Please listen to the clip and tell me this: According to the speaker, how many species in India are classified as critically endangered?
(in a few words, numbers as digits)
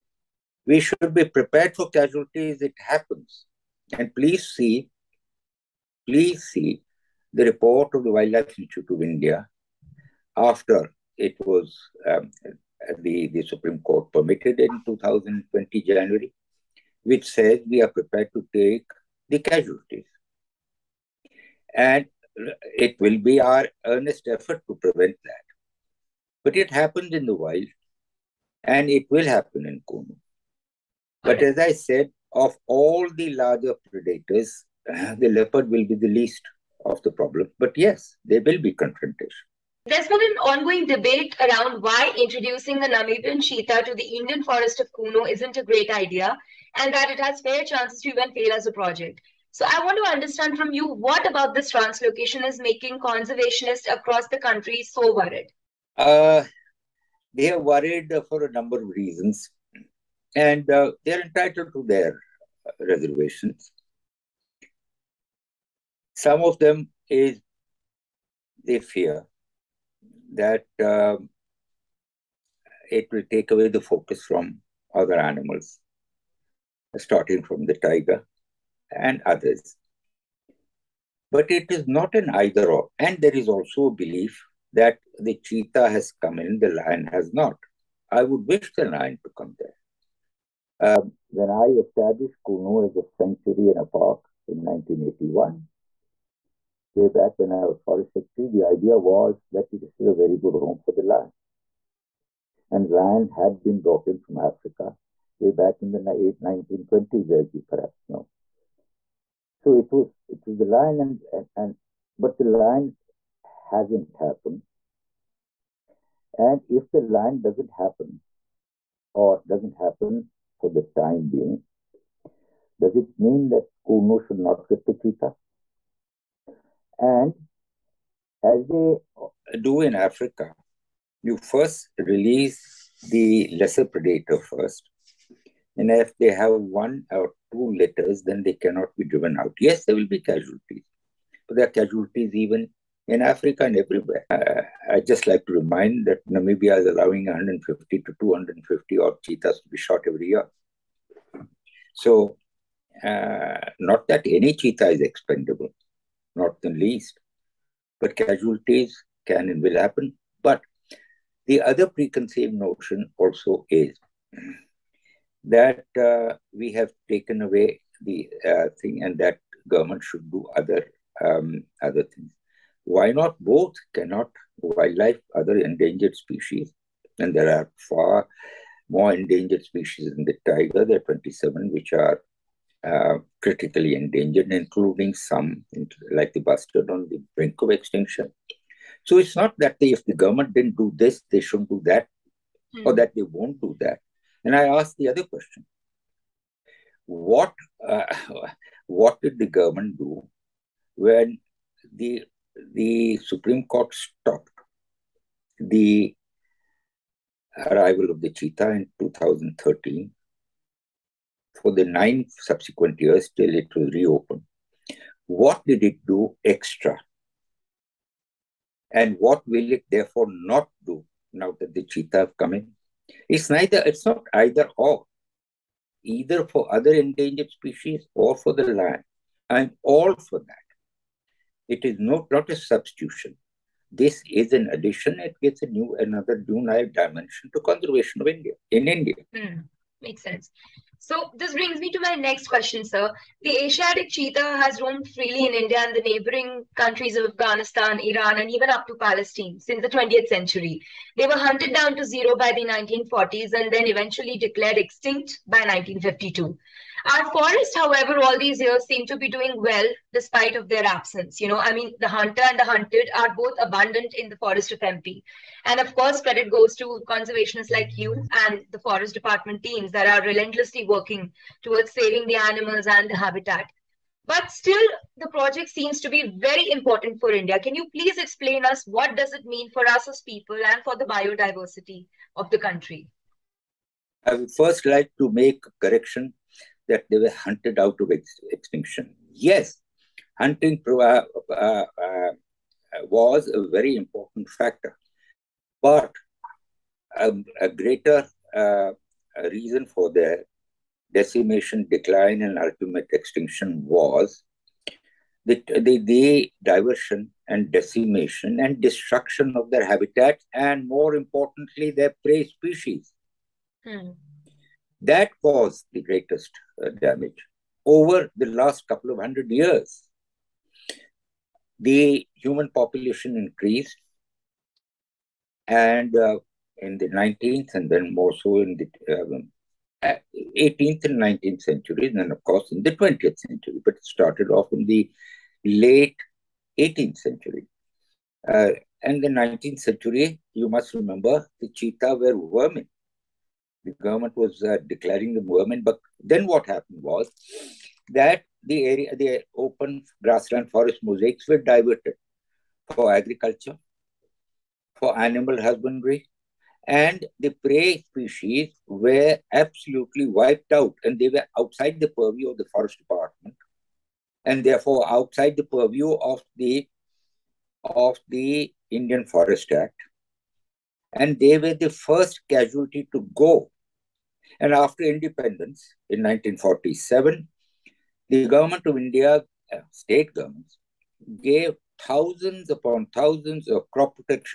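27.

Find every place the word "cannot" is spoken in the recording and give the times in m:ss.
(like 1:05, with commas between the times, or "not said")
2:18, 2:53.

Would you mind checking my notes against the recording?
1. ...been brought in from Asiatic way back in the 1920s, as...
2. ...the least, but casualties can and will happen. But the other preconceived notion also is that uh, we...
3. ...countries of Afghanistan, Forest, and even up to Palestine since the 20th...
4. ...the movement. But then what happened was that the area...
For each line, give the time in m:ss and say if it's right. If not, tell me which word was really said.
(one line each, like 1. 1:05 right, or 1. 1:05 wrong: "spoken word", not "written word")
1. 1:43 wrong: "Africa", not "Asiatic"
2. 2:36 right
3. 4:06 wrong: "Iran", not "Forest"
4. 5:45 right.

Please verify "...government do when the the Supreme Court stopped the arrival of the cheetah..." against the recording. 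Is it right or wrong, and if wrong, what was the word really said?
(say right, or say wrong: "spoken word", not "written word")
right.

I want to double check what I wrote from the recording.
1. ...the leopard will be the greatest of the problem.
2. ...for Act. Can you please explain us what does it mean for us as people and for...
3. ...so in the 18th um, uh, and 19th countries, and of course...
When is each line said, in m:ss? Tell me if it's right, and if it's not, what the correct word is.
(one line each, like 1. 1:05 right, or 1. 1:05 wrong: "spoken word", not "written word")
1. 0:35 wrong: "least", not "greatest"
2. 4:37 wrong: "India", not "Act"
3. 5:28 wrong: "centuries", not "countries".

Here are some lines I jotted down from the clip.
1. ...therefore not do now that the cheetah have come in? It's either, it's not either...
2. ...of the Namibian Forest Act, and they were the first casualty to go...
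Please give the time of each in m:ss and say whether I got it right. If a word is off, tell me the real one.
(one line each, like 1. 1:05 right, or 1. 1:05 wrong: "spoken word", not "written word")
1. 3:39 wrong: "neither", not "either"
2. 6:07 wrong: "Indian", not "Namibian".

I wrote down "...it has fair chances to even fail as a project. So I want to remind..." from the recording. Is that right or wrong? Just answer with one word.
wrong.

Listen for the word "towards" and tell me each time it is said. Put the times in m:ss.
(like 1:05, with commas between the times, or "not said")
4:31.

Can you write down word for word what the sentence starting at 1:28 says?
I would wish the lion to come there.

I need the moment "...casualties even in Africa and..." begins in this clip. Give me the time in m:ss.
2:21.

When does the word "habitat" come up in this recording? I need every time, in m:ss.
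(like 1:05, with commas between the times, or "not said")
4:33, 5:09.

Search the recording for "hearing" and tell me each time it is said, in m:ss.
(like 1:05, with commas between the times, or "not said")
not said.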